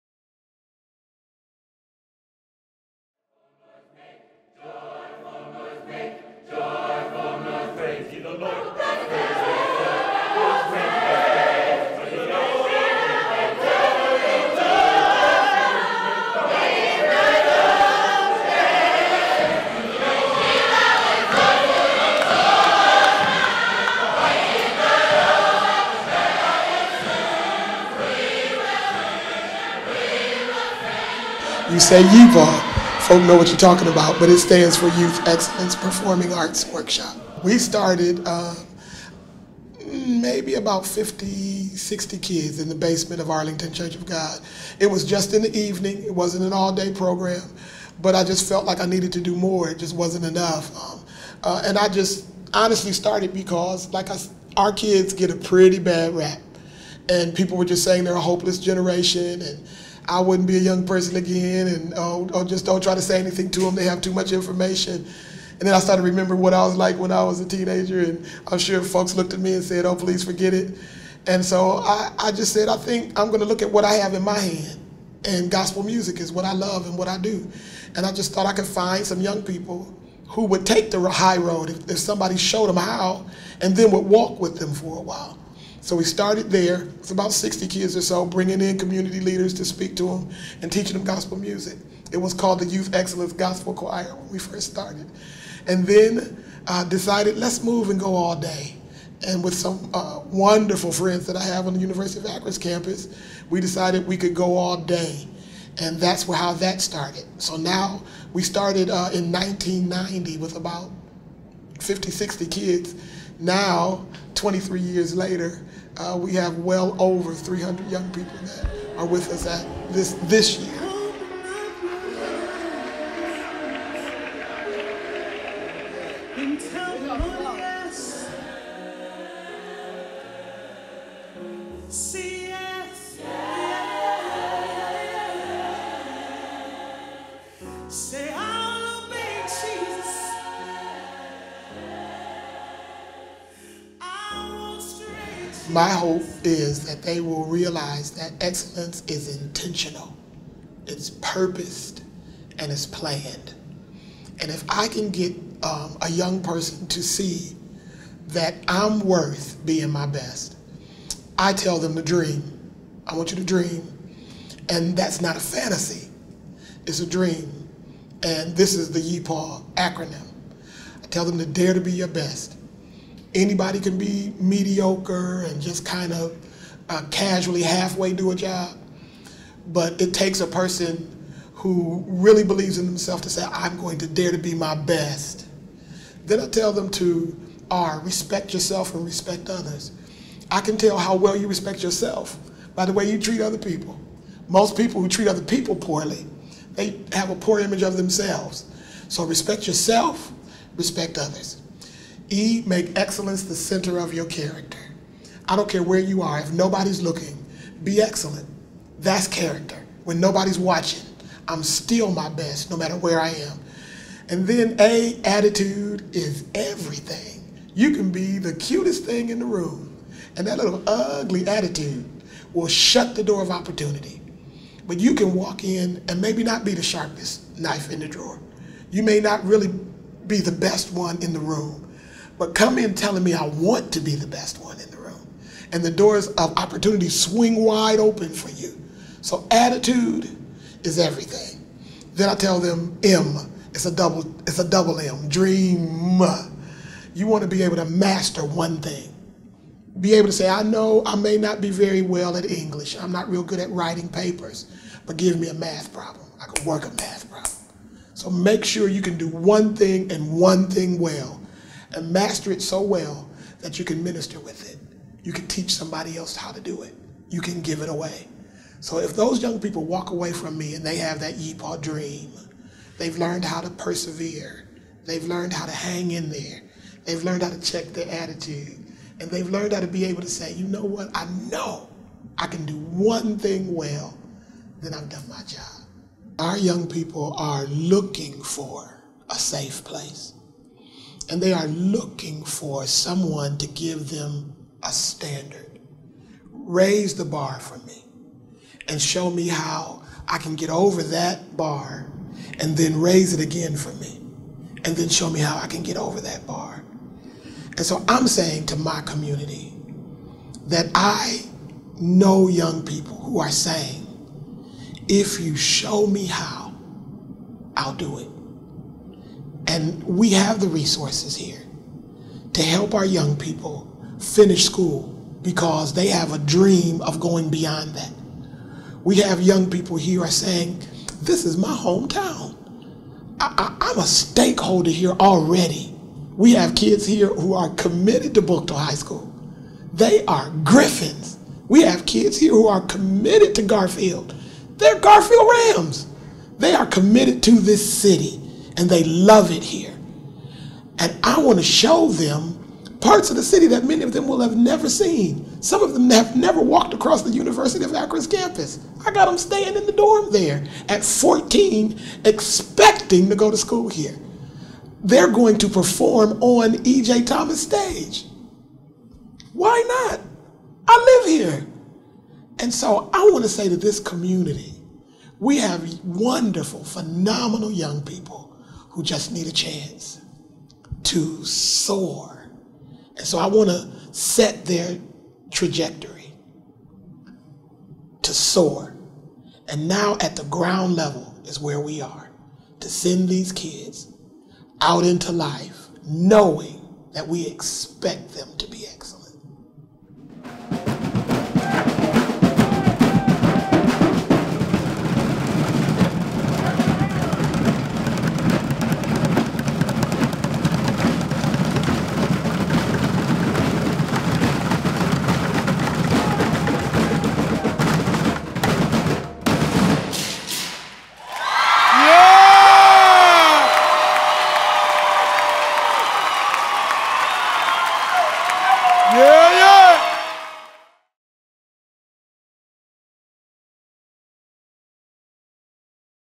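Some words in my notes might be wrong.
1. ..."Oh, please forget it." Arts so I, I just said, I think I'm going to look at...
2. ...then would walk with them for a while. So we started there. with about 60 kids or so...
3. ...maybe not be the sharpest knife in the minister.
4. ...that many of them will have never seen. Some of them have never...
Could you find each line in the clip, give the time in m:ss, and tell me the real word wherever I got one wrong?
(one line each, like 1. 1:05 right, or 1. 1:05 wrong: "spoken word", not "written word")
1. 1:09 wrong: "And", not "Arts"
2. 1:23 right
3. 3:46 wrong: "drawer", not "minister"
4. 5:53 right.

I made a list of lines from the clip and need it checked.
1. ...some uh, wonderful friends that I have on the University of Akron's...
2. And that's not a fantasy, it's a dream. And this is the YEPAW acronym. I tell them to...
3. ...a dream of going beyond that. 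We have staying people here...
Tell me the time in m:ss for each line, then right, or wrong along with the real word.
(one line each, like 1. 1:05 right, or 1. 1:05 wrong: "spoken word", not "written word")
1. 1:39 right
2. 2:44 right
3. 5:26 wrong: "young", not "staying".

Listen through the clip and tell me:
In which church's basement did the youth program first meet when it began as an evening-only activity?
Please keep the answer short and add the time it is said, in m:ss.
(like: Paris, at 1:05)
Arlington Church of God, at 0:43.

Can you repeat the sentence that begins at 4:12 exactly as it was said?
I'm not real good at writing papers, but give me a math problem.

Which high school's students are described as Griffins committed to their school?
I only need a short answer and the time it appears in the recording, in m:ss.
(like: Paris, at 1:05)
Buchtel High School, at 5:38.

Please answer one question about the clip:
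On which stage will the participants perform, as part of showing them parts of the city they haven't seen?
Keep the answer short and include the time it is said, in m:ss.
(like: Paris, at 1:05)
E.J. Thomas, at 6:06.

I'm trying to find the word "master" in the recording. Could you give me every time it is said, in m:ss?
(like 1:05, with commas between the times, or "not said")
4:07, 4:22.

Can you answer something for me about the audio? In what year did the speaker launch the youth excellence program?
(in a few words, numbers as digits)
1990.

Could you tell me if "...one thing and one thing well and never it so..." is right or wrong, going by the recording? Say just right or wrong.
wrong.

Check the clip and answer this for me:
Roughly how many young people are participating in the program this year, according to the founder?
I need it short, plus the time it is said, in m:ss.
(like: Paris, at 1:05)
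300, at 1:57.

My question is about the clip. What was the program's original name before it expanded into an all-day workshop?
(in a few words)
Youth Excellence Gospel Choir.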